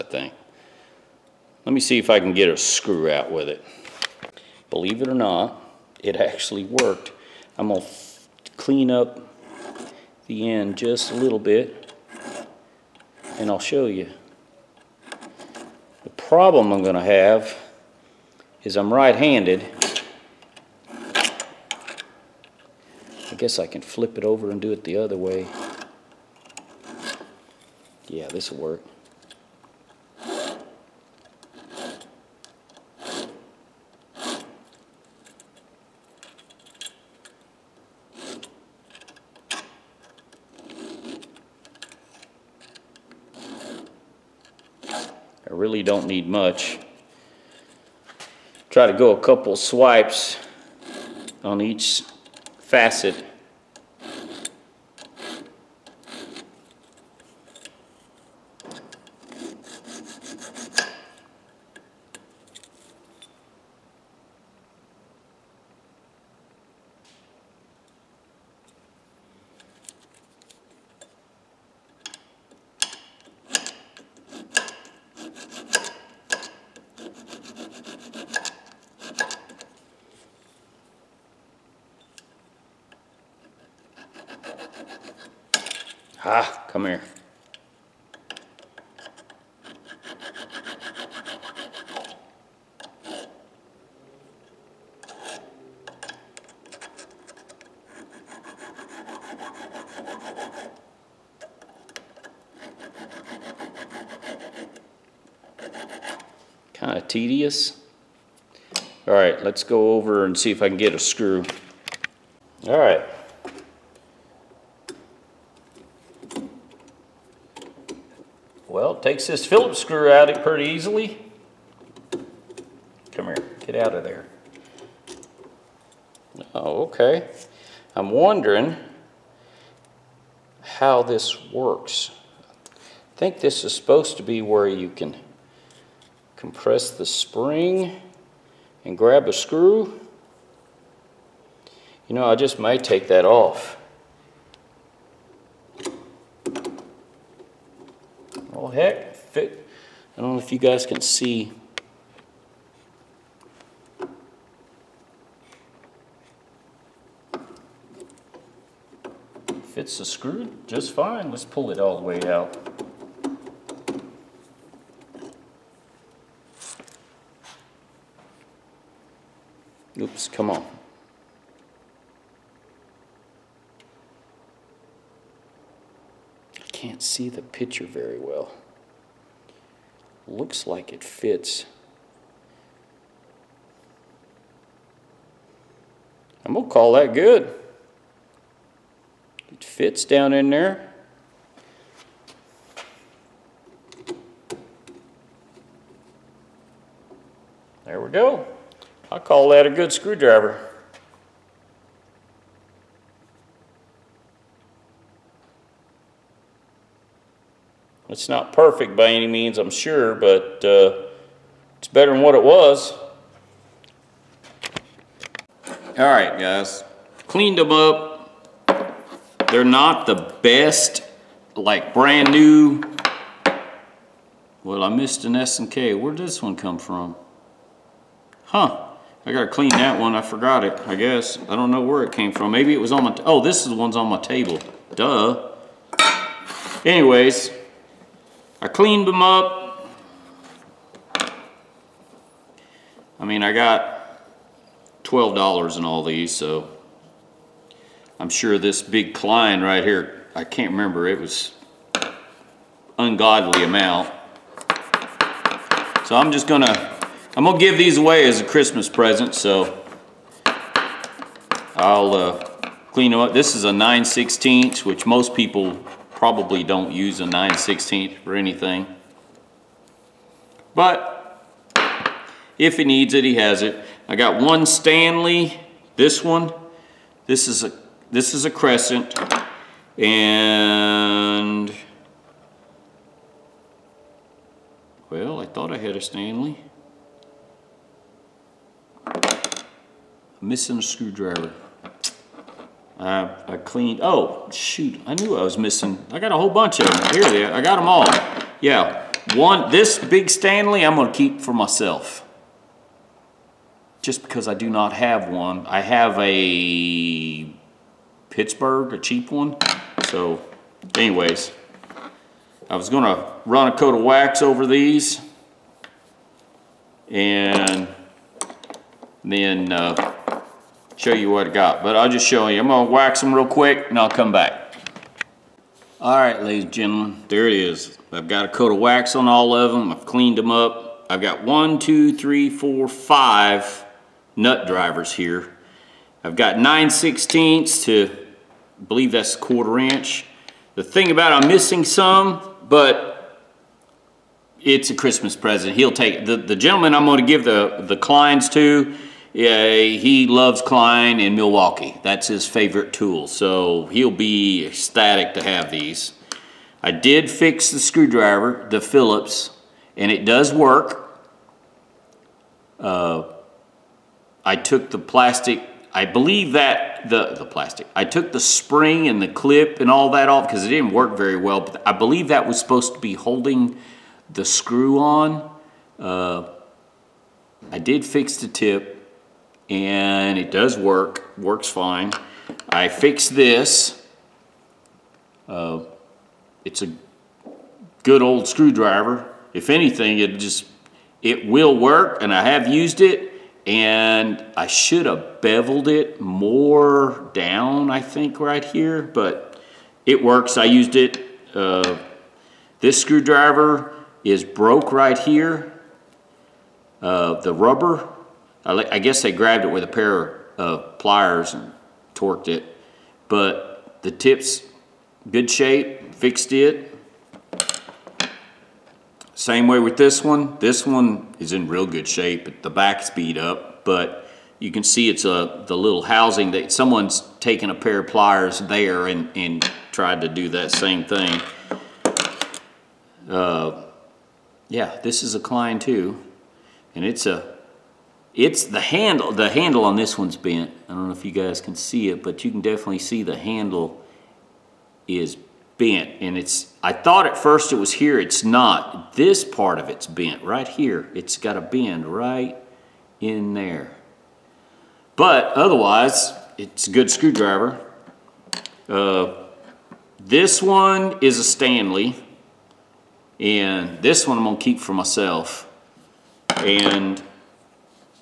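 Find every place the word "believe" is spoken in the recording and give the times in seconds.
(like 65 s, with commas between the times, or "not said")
4 s, 338 s, 366 s, 371 s.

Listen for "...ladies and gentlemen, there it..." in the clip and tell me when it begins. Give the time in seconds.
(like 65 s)
326 s.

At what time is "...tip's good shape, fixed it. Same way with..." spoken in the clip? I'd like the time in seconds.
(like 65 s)
414 s.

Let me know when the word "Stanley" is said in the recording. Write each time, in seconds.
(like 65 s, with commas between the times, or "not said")
274 s, 286 s, 300 s, 461 s.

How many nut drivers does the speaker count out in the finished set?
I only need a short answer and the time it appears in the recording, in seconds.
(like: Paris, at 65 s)
5, at 332 s.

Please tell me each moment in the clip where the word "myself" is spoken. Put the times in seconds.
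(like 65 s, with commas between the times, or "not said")
301 s, 464 s.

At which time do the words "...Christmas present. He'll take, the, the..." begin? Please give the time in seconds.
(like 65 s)
344 s.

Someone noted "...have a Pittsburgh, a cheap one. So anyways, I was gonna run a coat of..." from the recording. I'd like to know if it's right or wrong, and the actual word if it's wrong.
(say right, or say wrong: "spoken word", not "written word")
right.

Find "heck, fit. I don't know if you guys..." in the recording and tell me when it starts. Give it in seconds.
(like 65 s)
148 s.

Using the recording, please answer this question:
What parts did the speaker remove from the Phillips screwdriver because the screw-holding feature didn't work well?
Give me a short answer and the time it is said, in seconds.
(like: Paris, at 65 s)
the spring and the clip, at 368 s.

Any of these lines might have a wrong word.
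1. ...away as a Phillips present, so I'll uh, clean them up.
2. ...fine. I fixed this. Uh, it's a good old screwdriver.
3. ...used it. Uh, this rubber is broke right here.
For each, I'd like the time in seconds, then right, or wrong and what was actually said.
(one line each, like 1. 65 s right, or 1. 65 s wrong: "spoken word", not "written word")
1. 257 s wrong: "Christmas", not "Phillips"
2. 381 s right
3. 400 s wrong: "screwdriver", not "rubber".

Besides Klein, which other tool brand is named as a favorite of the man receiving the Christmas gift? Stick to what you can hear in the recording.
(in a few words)
Milwaukee.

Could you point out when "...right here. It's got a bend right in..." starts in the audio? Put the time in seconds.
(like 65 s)
450 s.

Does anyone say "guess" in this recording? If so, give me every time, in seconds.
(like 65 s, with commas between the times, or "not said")
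23 s, 230 s, 408 s.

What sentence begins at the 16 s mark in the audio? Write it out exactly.
The problem I'm going to have is I'm right-handed.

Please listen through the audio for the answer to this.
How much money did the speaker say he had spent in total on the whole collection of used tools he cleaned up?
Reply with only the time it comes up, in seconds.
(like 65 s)
245 s.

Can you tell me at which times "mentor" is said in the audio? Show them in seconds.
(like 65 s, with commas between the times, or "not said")
not said.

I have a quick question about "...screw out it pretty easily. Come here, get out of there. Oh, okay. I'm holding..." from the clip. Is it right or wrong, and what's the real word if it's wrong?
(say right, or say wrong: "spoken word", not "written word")
wrong: "wondering", not "holding".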